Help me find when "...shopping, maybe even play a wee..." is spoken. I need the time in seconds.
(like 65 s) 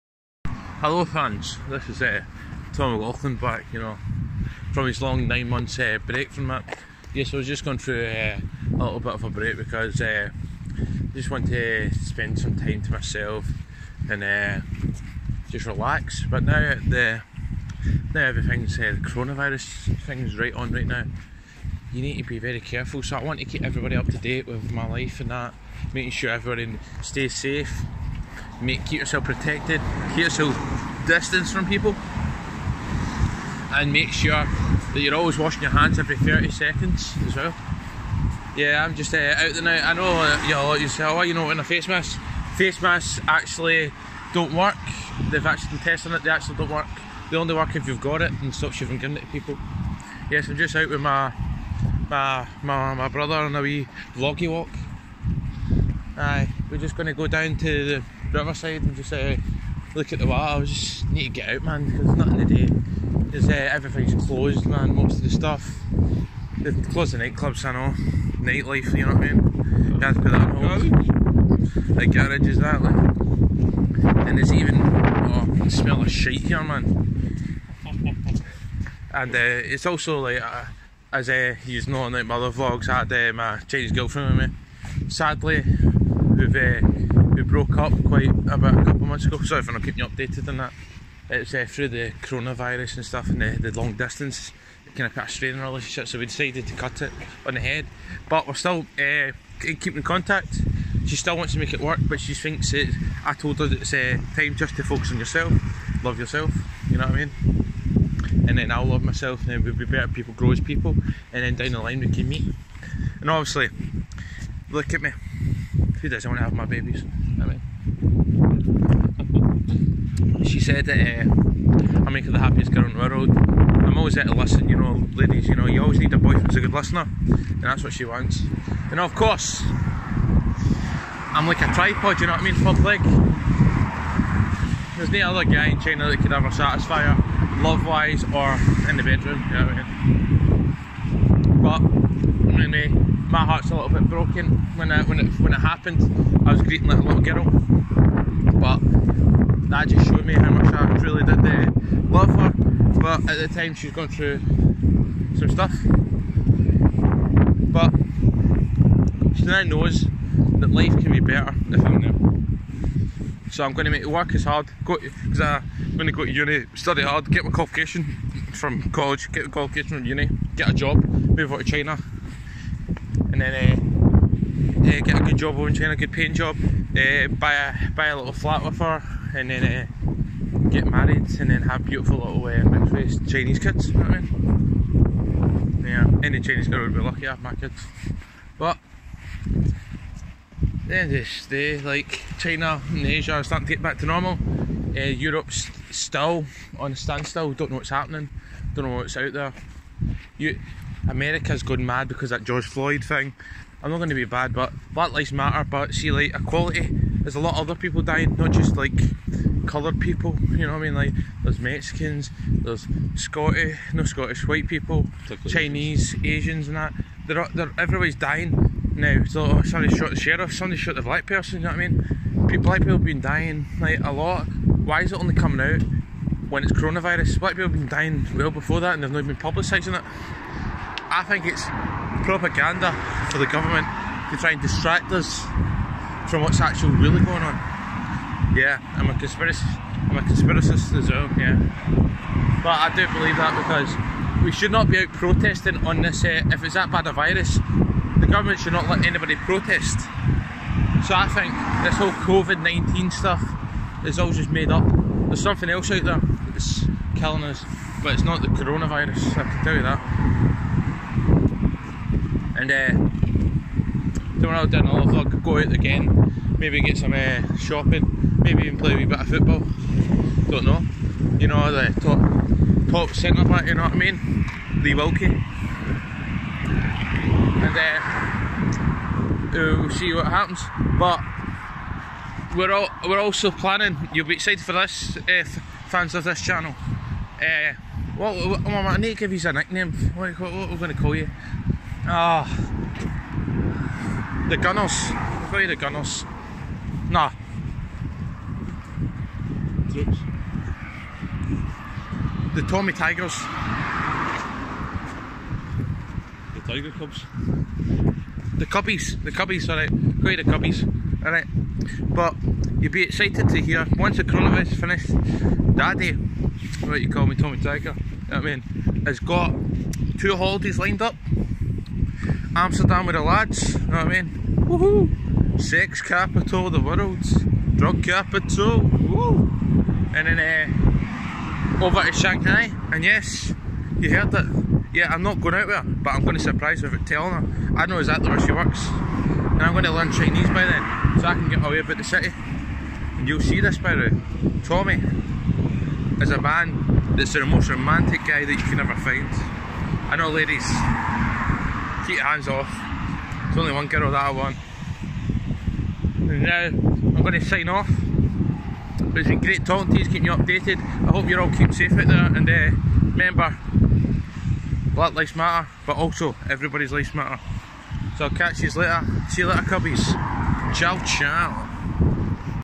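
267 s.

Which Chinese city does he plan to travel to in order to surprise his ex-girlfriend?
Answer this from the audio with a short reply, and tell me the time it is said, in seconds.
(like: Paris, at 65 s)
Shanghai, at 332 s.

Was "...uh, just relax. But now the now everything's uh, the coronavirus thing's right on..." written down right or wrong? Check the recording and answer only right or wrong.
right.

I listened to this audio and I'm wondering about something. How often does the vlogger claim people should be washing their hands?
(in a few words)
Every 30 seconds.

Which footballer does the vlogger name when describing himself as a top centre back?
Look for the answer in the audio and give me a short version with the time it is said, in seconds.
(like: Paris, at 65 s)
Lee Wilkie, at 274 s.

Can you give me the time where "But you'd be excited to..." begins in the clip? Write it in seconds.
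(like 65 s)
312 s.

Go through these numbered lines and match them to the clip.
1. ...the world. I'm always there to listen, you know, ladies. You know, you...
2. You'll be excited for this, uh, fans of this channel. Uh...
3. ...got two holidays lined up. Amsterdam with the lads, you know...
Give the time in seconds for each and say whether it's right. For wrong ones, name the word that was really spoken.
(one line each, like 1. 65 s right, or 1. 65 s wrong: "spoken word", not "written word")
1. 122 s right
2. 284 s right
3. 319 s right.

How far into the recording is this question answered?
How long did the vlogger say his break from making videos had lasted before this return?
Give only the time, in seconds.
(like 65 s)
5 s.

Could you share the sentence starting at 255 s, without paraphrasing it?
There's something else out there that's killing us, but it's not the coronavirus, I can tell you that.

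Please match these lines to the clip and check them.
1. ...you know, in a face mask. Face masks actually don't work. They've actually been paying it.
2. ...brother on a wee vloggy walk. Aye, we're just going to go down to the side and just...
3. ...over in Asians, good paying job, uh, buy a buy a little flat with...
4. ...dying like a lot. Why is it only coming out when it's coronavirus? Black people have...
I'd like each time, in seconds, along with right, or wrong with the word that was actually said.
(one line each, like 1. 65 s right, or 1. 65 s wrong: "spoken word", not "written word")
1. 41 s wrong: "testing", not "paying"
2. 53 s right
3. 175 s wrong: "China", not "Asians"
4. 223 s right.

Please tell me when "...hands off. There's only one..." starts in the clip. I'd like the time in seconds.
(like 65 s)
352 s.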